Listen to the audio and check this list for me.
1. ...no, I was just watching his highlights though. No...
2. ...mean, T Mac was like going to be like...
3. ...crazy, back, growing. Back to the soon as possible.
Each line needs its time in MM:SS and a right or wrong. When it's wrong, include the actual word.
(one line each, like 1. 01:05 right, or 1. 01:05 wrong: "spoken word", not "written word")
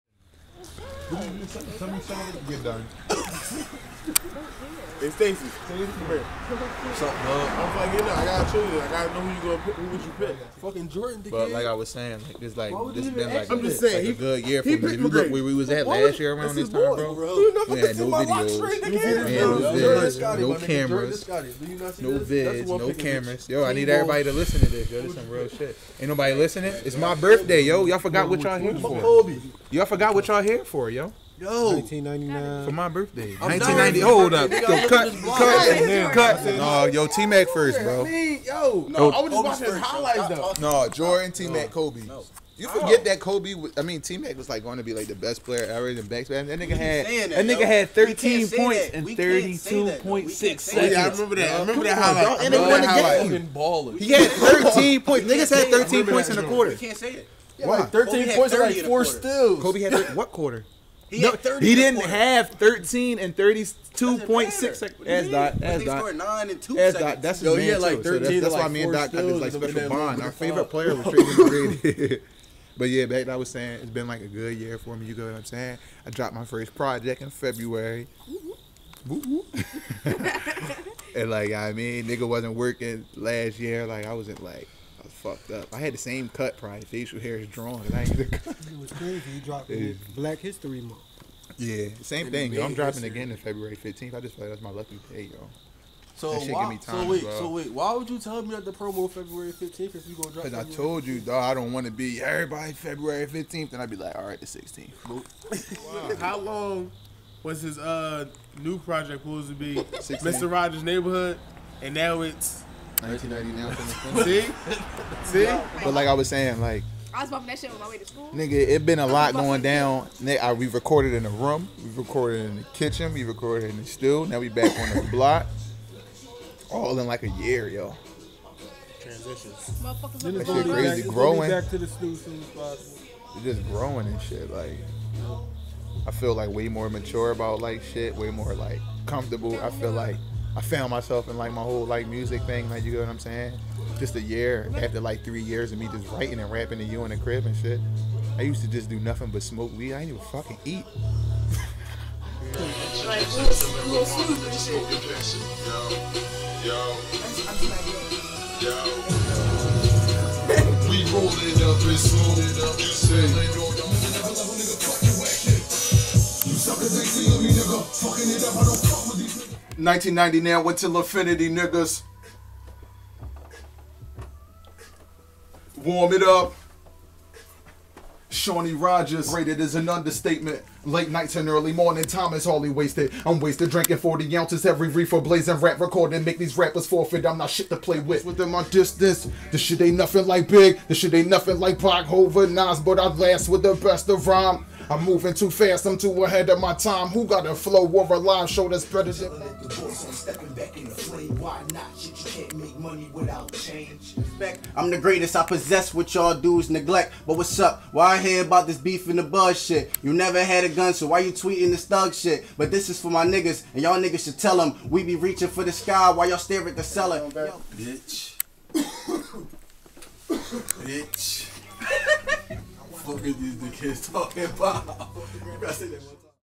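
1. 00:38 right
2. 00:43 right
3. 02:10 right.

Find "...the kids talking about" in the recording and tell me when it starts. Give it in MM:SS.
03:43.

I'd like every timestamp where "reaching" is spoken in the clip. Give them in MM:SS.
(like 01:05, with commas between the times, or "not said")
03:35.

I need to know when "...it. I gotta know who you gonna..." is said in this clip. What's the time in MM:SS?
00:08.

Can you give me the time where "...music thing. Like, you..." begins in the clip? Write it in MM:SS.
02:22.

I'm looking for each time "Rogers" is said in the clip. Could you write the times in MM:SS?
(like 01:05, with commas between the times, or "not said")
01:50, 02:58.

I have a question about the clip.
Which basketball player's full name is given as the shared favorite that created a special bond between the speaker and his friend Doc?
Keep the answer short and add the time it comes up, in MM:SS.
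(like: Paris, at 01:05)
Tracy McGrady, at 01:11.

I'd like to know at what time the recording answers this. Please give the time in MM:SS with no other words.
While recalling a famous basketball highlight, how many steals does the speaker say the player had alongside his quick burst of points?
00:58.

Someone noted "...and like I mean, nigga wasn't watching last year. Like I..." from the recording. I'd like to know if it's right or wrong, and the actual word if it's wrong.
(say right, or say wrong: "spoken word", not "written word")
wrong: "working", not "watching".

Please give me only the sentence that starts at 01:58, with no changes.
Nigga, it been a lot going down.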